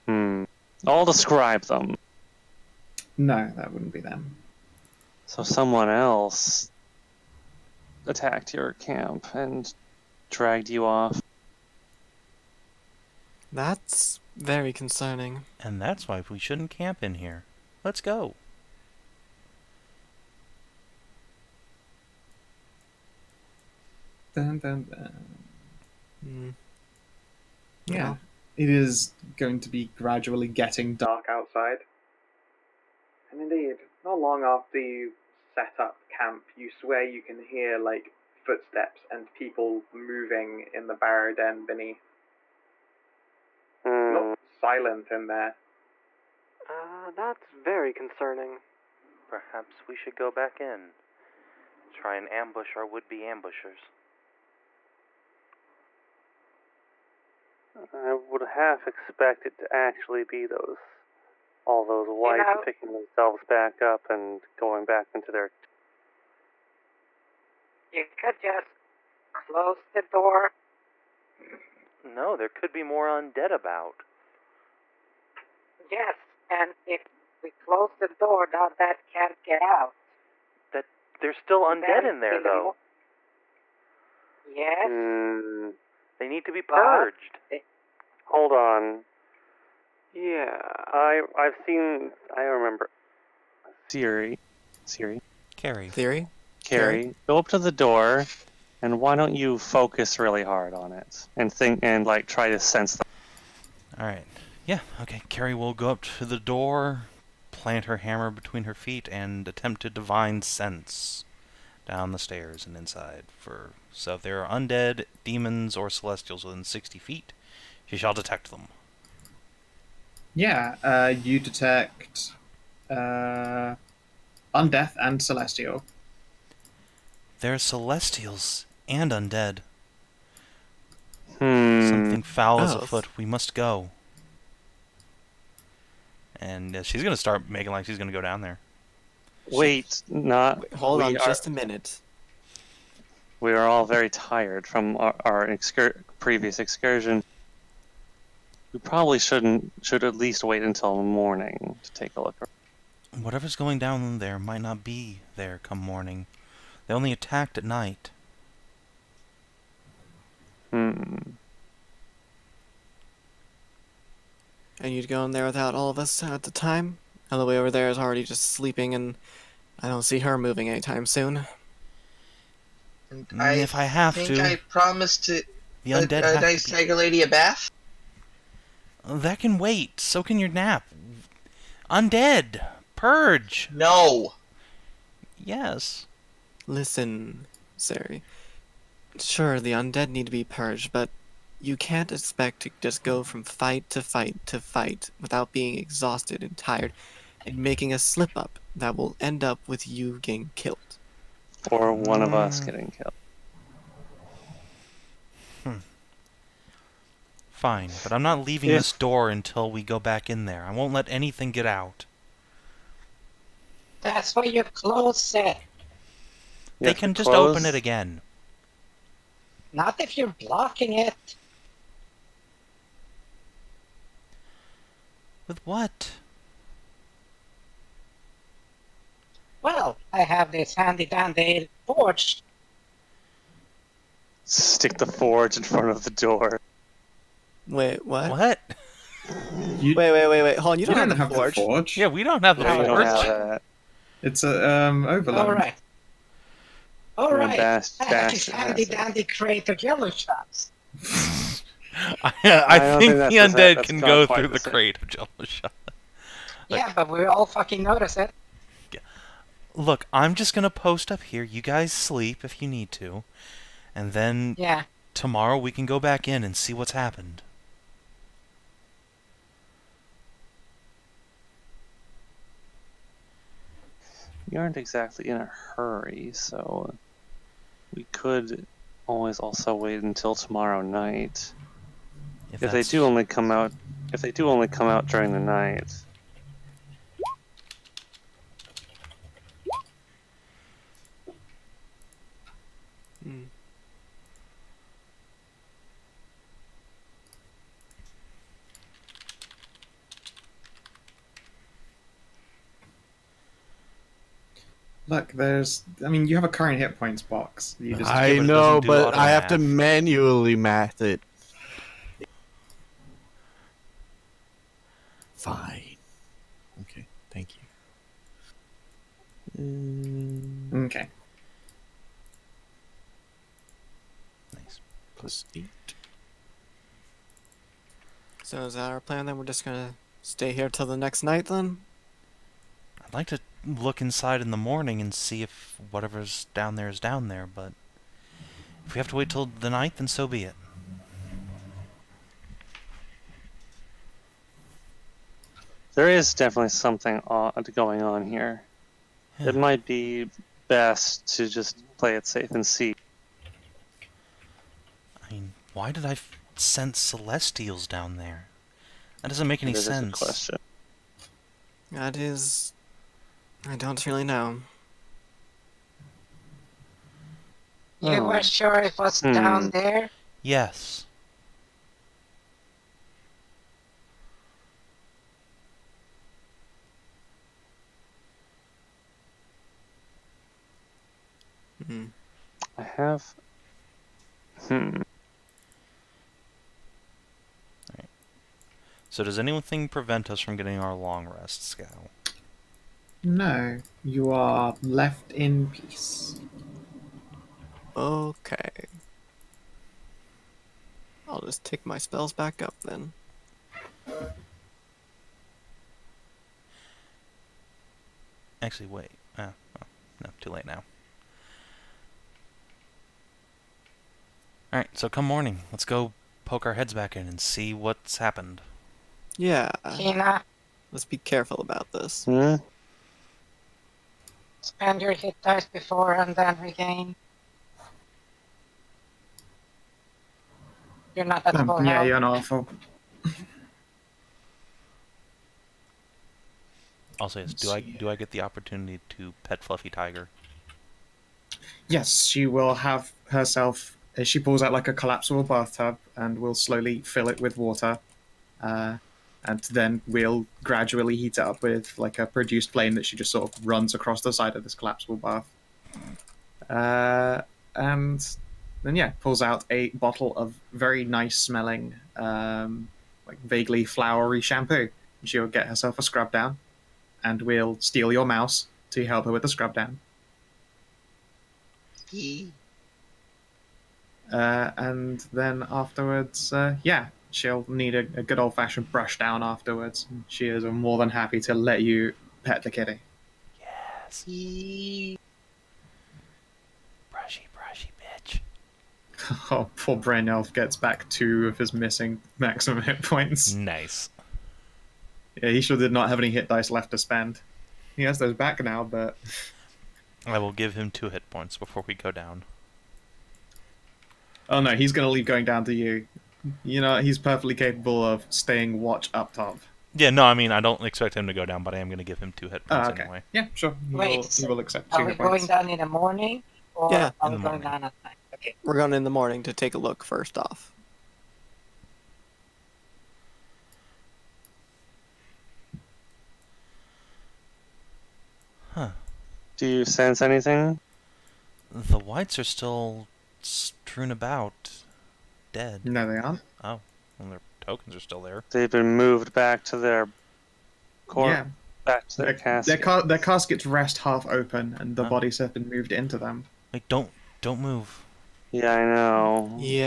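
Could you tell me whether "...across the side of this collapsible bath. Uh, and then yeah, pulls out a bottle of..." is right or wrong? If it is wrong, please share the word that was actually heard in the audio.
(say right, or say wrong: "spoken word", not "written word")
right.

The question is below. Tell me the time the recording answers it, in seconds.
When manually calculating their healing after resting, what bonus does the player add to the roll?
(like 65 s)
325 s.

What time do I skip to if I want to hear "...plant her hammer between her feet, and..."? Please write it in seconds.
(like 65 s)
107 s.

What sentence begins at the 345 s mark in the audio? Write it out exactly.
There is definitely something odd going on here.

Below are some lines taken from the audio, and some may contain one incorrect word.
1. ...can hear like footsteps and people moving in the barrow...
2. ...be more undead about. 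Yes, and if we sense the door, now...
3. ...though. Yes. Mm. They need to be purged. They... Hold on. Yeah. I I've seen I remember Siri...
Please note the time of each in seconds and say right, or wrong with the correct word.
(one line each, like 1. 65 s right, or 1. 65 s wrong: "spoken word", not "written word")
1. 37 s right
2. 72 s wrong: "close", not "sense"
3. 82 s right.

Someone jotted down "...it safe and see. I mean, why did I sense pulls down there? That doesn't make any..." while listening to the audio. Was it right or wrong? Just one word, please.
wrong.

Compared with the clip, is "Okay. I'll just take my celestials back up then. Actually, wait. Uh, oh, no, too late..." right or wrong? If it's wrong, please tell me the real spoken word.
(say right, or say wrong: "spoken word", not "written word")
wrong: "spells", not "celestials".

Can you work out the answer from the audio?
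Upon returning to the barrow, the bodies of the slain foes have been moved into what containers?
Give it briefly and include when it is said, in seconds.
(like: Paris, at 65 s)
Caskets, at 542 s.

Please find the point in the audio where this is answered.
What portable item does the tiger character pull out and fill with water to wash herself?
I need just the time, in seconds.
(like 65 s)
444 s.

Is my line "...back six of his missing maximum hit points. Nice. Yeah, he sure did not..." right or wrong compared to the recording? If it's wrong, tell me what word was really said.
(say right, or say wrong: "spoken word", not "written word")
wrong: "two", not "six".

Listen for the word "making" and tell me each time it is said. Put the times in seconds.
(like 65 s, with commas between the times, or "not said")
137 s, 197 s.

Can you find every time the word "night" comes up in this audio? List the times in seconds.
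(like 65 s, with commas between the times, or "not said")
157 s, 280 s, 285 s, 331 s, 339 s, 518 s.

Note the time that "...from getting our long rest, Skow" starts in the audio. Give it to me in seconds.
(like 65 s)
390 s.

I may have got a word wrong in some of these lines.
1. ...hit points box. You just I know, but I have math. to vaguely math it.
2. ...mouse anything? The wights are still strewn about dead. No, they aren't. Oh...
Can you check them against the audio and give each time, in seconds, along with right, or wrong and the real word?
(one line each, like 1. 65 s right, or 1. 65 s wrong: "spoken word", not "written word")
1. 306 s wrong: "manually", not "vaguely"
2. 529 s wrong: "sense", not "mouse".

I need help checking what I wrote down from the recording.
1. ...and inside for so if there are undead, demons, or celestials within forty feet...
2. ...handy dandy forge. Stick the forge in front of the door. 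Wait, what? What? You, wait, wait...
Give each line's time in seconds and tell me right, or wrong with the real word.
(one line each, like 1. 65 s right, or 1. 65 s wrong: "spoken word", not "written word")
1. 112 s wrong: "sixty", not "forty"
2. 230 s right.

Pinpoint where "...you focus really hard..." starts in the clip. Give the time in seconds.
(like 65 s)
99 s.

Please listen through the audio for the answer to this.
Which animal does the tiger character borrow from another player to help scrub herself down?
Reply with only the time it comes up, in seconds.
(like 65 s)
468 s.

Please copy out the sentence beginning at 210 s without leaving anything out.
I won't let anything get out.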